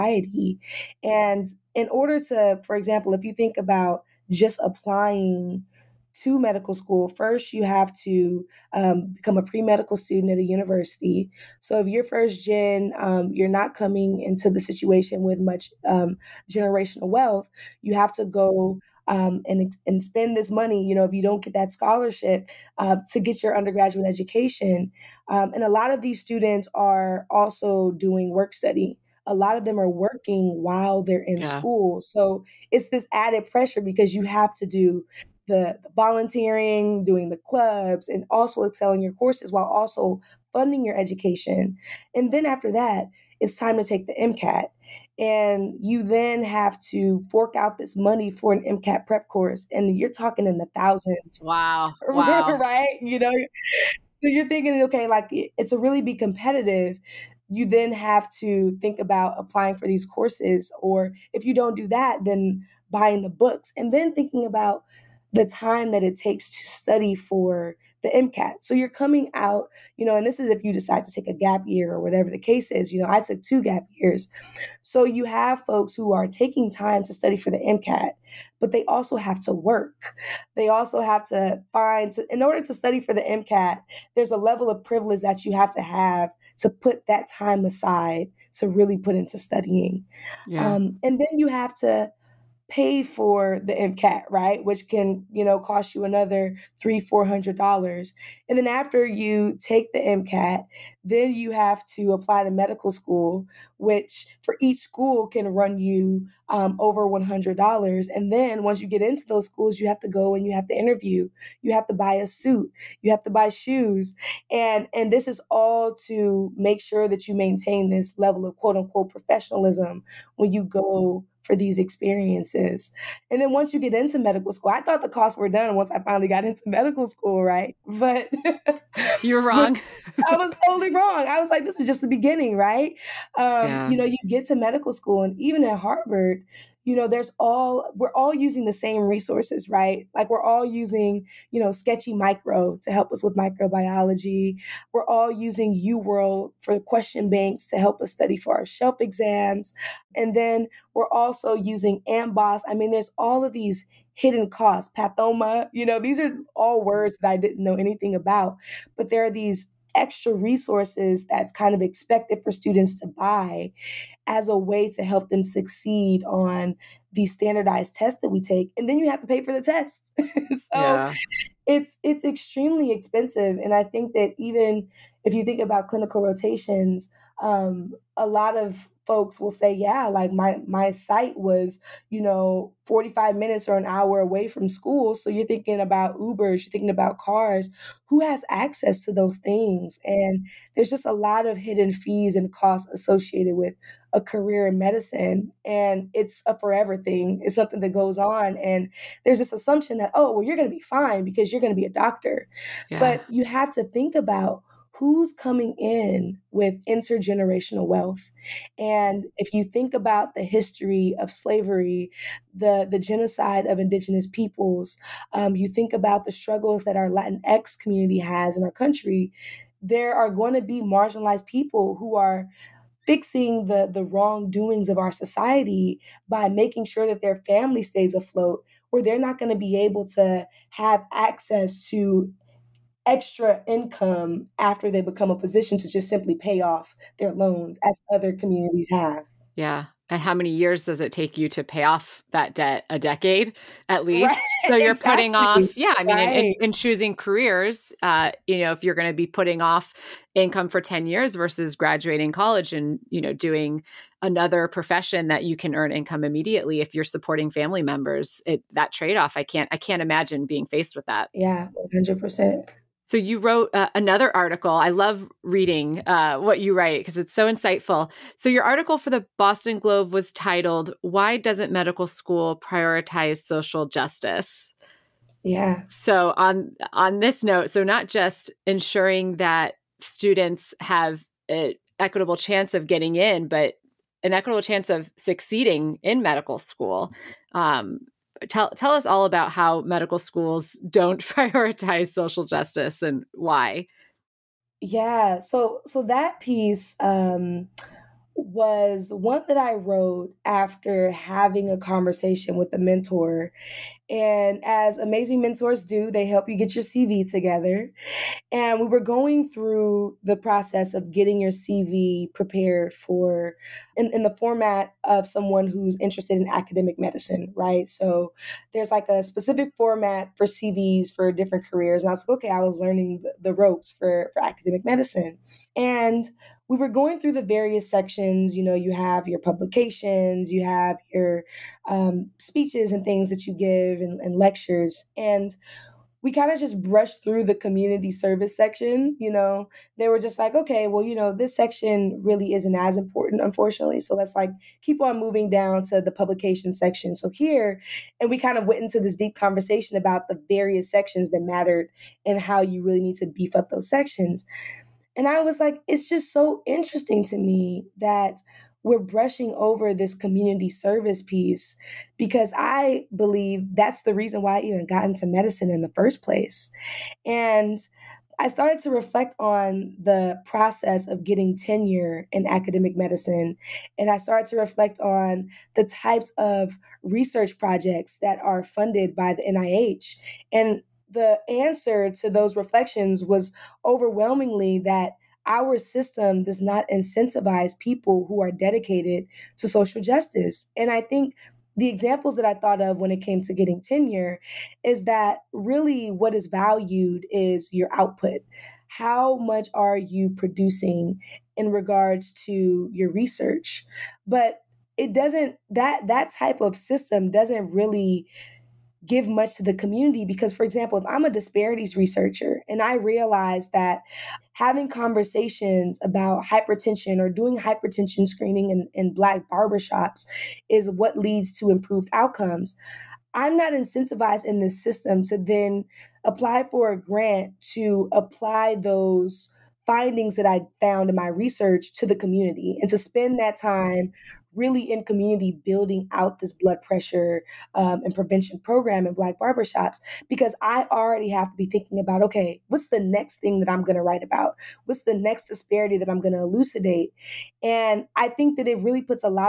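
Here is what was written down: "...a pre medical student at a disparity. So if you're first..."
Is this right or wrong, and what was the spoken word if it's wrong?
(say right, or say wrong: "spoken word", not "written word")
wrong: "university", not "disparity".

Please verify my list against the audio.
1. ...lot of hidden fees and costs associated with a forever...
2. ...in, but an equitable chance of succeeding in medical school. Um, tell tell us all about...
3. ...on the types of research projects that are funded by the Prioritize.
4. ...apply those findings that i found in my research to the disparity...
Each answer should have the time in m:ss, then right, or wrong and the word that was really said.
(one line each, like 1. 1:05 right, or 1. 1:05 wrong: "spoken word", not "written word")
1. 3:11 wrong: "career", not "forever"
2. 4:43 right
3. 6:14 wrong: "NIH", not "Prioritize"
4. 7:08 wrong: "community", not "disparity".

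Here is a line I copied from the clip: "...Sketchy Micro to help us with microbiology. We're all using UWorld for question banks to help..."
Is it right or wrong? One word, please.
right.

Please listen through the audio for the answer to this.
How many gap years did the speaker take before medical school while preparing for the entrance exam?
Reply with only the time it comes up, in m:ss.
1:13.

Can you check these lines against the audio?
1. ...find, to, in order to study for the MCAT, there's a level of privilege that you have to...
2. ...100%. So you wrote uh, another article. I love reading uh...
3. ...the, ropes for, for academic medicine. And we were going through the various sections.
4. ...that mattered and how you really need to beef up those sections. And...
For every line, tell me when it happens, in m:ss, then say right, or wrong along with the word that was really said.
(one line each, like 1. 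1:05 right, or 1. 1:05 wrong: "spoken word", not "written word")
1. 1:21 right
2. 4:21 right
3. 5:23 right
4. 5:51 right.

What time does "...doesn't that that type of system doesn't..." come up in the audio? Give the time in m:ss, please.
6:45.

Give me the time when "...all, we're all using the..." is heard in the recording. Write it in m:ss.
2:17.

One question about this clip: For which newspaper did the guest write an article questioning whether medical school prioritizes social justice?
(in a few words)
Boston Globe.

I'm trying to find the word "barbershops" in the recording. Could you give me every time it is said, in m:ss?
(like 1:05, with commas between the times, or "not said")
6:59, 7:19.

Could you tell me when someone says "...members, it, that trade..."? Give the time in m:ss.
4:17.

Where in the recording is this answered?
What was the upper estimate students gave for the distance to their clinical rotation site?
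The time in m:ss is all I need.
3:03.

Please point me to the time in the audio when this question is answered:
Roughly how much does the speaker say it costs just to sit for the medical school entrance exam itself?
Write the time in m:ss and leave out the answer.
1:36.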